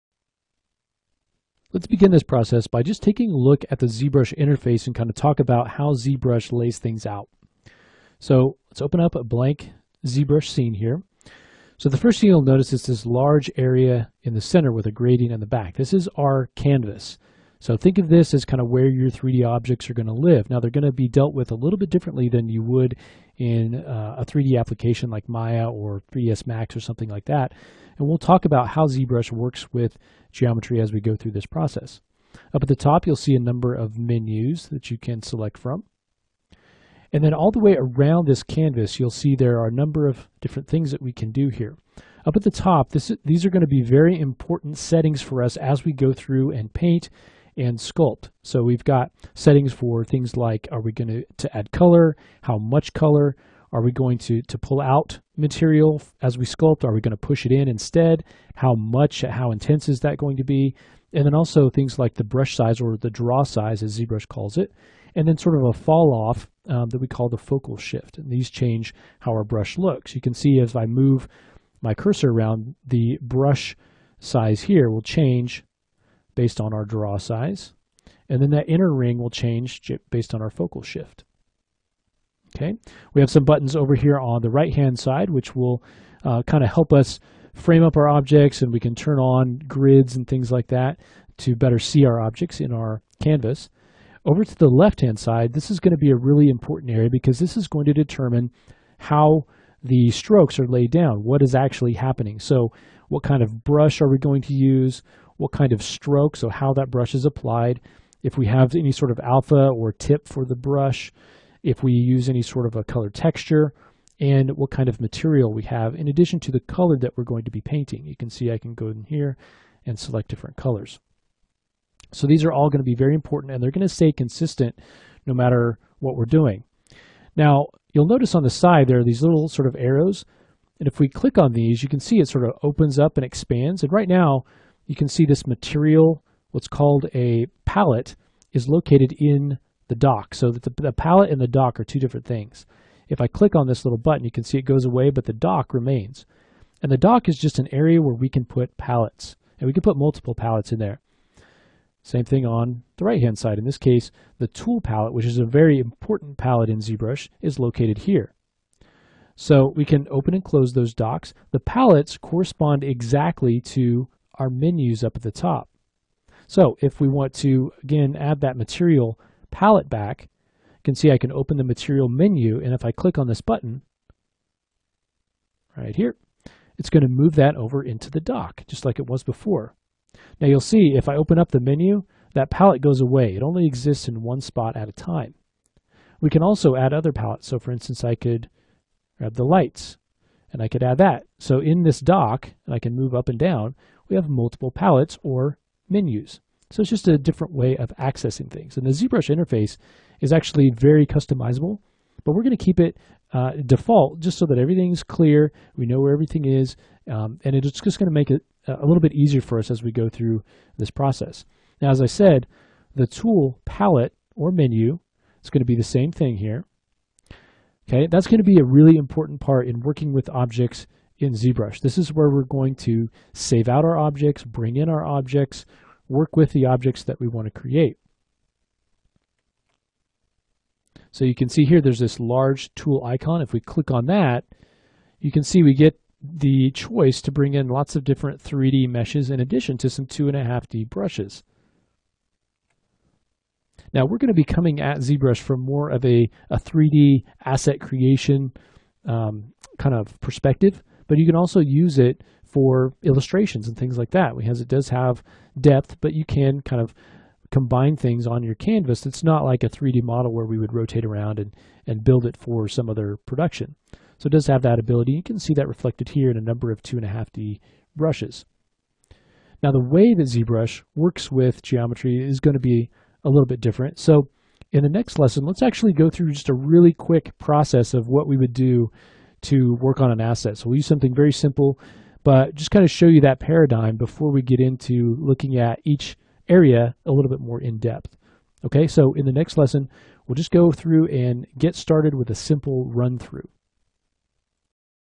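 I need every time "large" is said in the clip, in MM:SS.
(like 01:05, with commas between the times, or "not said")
00:13, 03:52.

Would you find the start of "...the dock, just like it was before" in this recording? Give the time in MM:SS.
02:58.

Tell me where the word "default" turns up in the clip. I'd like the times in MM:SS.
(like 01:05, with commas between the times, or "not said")
03:23.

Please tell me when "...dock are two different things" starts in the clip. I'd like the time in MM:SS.
02:21.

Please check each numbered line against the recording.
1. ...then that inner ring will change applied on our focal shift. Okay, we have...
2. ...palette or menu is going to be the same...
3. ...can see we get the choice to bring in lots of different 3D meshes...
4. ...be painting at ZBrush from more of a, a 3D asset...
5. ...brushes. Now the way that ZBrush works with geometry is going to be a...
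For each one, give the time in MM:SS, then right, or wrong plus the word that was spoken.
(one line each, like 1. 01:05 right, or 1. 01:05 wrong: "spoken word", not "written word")
1. 01:18 wrong: "based", not "applied"
2. 03:33 right
3. 03:55 right
4. 04:04 wrong: "coming", not "painting"
5. 04:27 right.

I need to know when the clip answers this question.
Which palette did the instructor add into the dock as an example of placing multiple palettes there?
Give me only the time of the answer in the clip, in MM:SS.
03:09.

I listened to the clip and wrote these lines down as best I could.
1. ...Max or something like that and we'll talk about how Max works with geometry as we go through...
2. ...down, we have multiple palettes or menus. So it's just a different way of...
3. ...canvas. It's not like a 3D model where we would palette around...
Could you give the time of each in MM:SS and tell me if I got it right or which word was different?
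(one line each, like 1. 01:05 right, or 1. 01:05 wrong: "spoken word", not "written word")
1. 00:26 wrong: "ZBrush", not "Max"
2. 03:13 right
3. 04:18 wrong: "rotate", not "palette".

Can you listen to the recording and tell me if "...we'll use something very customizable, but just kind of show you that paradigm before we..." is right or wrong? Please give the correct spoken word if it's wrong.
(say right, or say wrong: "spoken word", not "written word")
wrong: "simple", not "customizable".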